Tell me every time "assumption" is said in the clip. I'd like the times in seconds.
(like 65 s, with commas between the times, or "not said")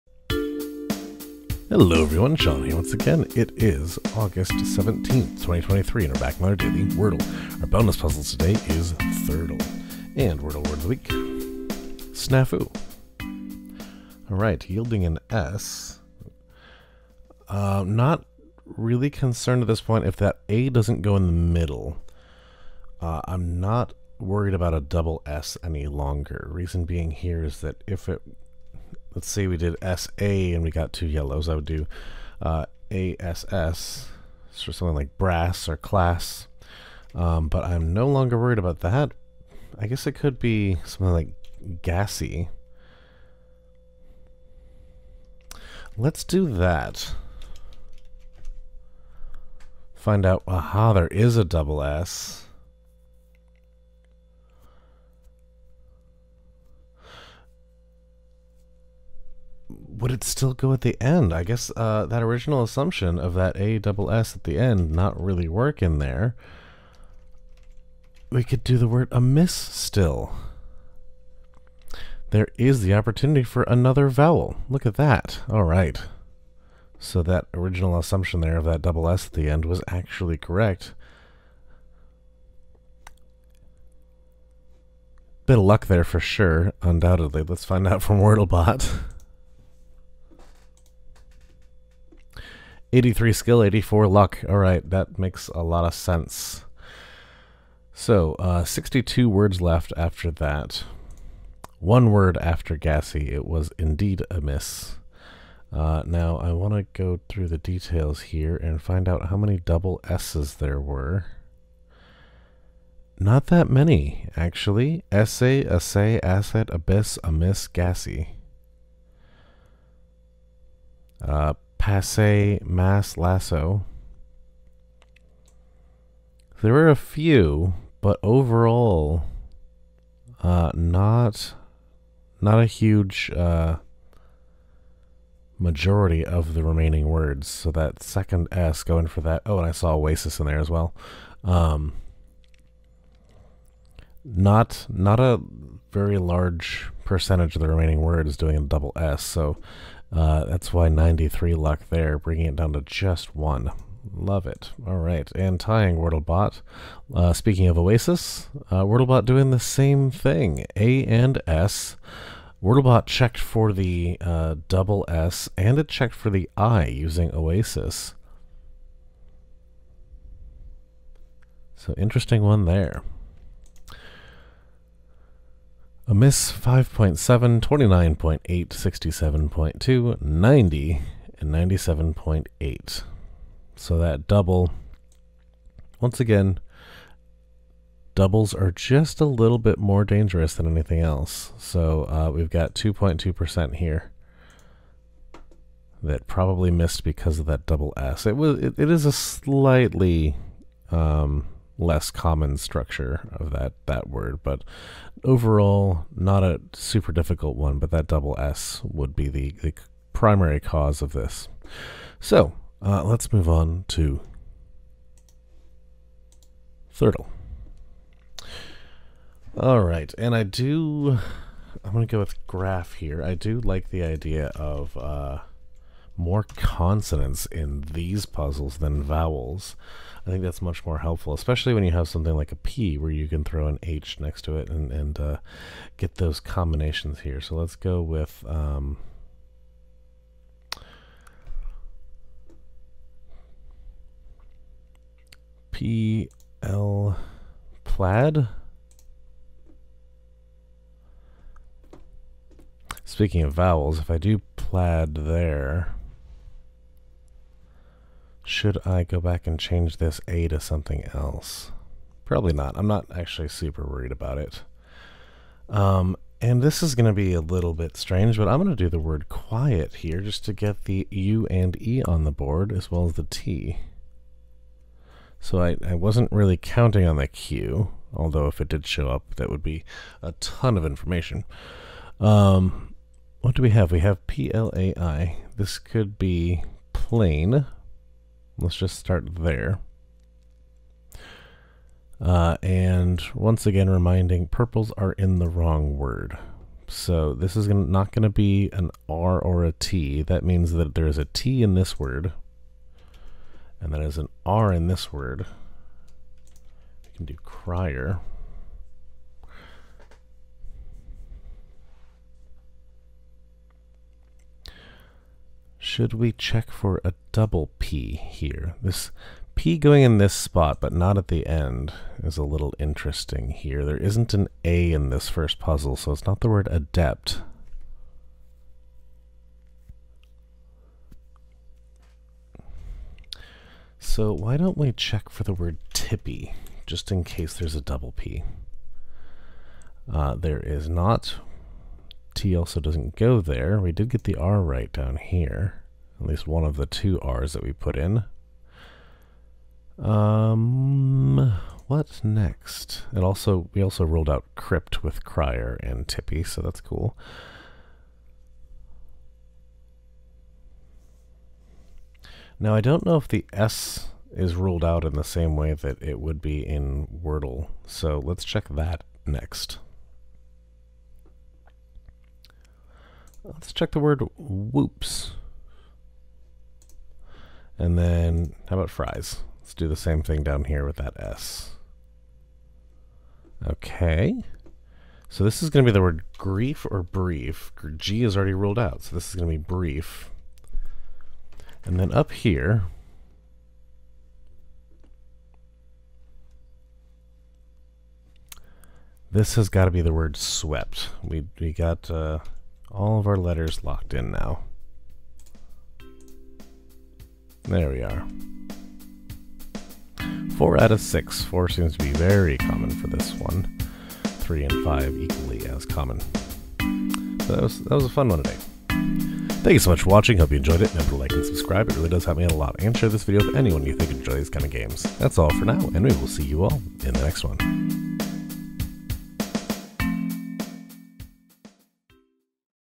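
62 s, 77 s.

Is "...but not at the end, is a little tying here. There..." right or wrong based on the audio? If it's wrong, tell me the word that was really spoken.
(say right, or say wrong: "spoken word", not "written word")
wrong: "interesting", not "tying".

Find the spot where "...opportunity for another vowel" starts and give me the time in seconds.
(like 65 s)
72 s.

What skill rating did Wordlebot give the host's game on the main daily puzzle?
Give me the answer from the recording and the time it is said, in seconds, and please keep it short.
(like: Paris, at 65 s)
83, at 92 s.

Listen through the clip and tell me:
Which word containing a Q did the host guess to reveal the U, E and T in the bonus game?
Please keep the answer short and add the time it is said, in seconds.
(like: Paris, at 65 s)
quiet, at 269 s.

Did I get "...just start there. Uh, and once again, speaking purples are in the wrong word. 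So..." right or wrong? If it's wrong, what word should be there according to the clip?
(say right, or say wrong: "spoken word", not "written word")
wrong: "reminding", not "speaking".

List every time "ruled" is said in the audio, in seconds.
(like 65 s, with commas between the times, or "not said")
364 s, 388 s.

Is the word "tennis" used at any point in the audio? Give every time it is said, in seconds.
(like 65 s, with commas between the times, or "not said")
not said.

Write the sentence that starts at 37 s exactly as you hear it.
Um, but I'm no longer worried about that.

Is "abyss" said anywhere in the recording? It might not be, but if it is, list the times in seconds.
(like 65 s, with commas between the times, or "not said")
116 s.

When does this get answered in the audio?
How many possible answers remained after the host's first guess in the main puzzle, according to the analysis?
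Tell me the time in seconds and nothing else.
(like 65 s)
98 s.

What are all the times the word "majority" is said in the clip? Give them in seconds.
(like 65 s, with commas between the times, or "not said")
135 s.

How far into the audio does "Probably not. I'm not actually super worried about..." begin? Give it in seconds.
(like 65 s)
262 s.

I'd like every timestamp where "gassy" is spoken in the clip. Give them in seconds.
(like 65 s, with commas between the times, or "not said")
41 s, 102 s, 117 s.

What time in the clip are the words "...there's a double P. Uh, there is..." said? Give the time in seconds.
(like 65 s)
337 s.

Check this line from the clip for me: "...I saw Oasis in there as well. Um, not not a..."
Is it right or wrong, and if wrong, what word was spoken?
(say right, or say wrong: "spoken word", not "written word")
right.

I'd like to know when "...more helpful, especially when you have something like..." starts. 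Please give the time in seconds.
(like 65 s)
230 s.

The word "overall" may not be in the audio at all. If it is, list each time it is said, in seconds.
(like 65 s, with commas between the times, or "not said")
128 s, 205 s.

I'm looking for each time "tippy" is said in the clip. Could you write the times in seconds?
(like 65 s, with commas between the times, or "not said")
335 s, 356 s.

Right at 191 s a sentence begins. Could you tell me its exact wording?
So uh, we've got 2.2% here that probably missed because of that double S.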